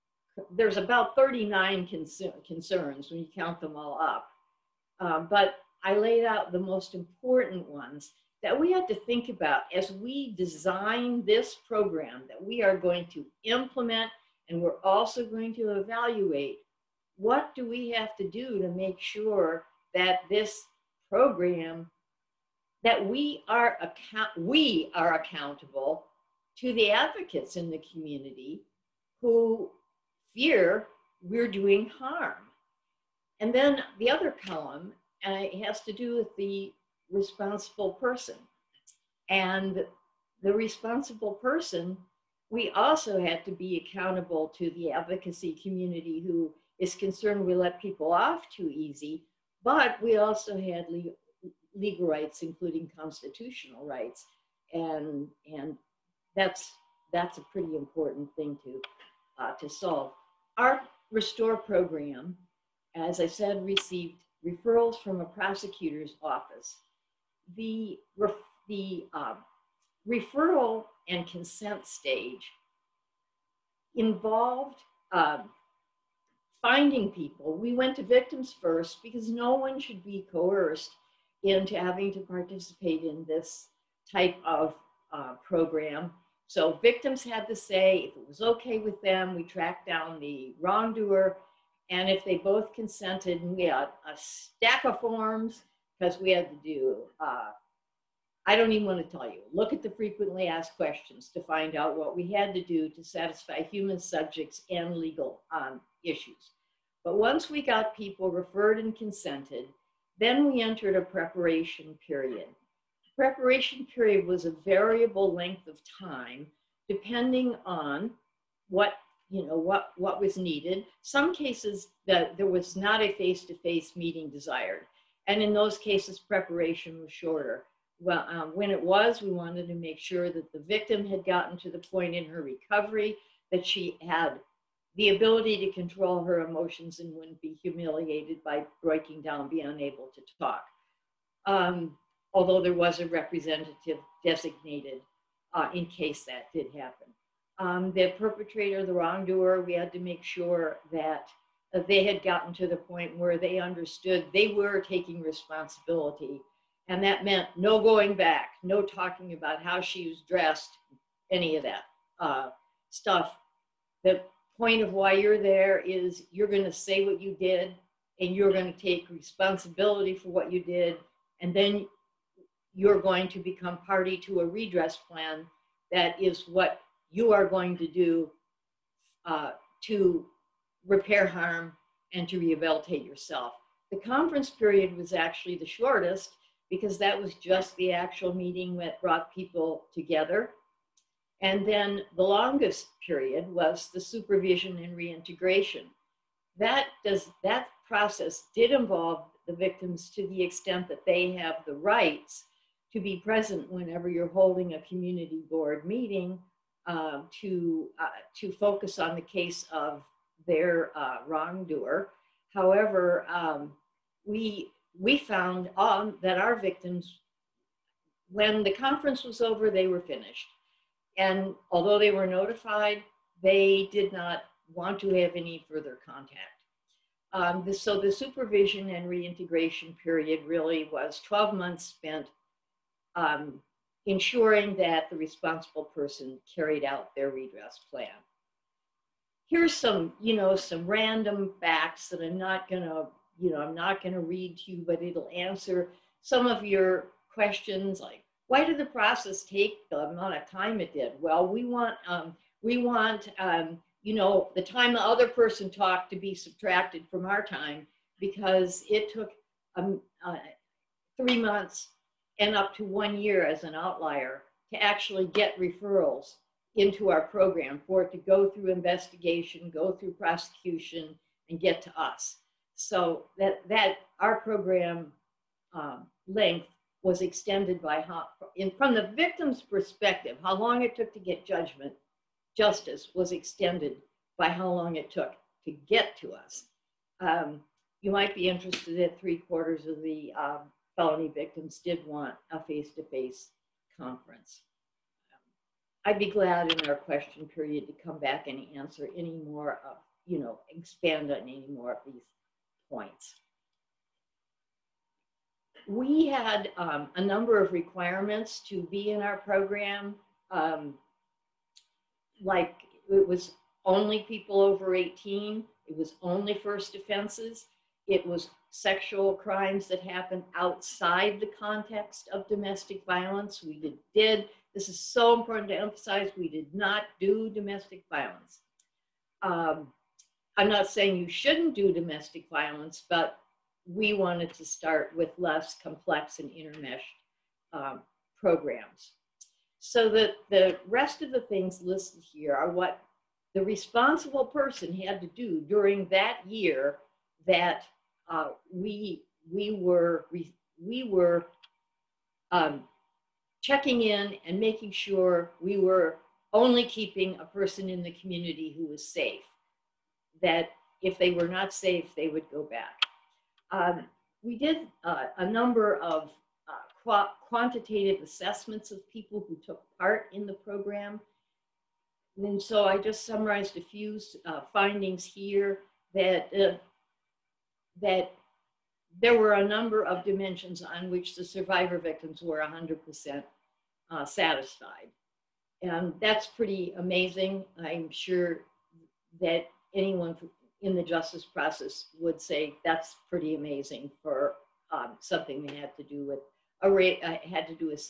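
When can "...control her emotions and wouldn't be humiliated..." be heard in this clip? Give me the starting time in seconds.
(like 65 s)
135 s.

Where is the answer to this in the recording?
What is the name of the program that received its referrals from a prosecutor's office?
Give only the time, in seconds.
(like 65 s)
61 s.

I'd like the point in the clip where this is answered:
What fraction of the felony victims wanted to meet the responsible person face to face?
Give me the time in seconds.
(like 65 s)
289 s.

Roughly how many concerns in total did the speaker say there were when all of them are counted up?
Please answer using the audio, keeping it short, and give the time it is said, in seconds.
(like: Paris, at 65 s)
39, at 1 s.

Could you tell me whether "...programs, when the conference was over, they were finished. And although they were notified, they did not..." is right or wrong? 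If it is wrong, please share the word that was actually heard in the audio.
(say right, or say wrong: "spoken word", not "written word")
wrong: "victims", not "programs".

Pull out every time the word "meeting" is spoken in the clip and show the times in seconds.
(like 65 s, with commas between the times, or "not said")
123 s, 188 s, 205 s.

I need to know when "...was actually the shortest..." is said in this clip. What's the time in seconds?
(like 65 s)
184 s.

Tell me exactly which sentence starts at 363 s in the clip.
Um, we did uh, a number of uh, quantitative assessments of people who took part in the program.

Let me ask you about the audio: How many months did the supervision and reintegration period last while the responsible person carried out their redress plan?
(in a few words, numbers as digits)
12 months.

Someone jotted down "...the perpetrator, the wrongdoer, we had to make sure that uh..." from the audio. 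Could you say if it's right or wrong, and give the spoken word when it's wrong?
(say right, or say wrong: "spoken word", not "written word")
right.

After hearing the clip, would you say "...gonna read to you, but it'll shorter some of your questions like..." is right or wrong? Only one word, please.
wrong.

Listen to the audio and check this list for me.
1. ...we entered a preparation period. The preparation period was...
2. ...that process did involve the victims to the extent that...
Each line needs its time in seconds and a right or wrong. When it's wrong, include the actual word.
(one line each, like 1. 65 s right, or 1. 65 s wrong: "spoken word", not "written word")
1. 110 s right
2. 197 s right.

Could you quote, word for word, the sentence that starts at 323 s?
We did, did this is so important to emphasize, we did not do domestic violence.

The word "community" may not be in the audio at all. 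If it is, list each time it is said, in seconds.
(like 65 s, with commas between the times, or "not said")
27 s, 45 s, 204 s, 358 s.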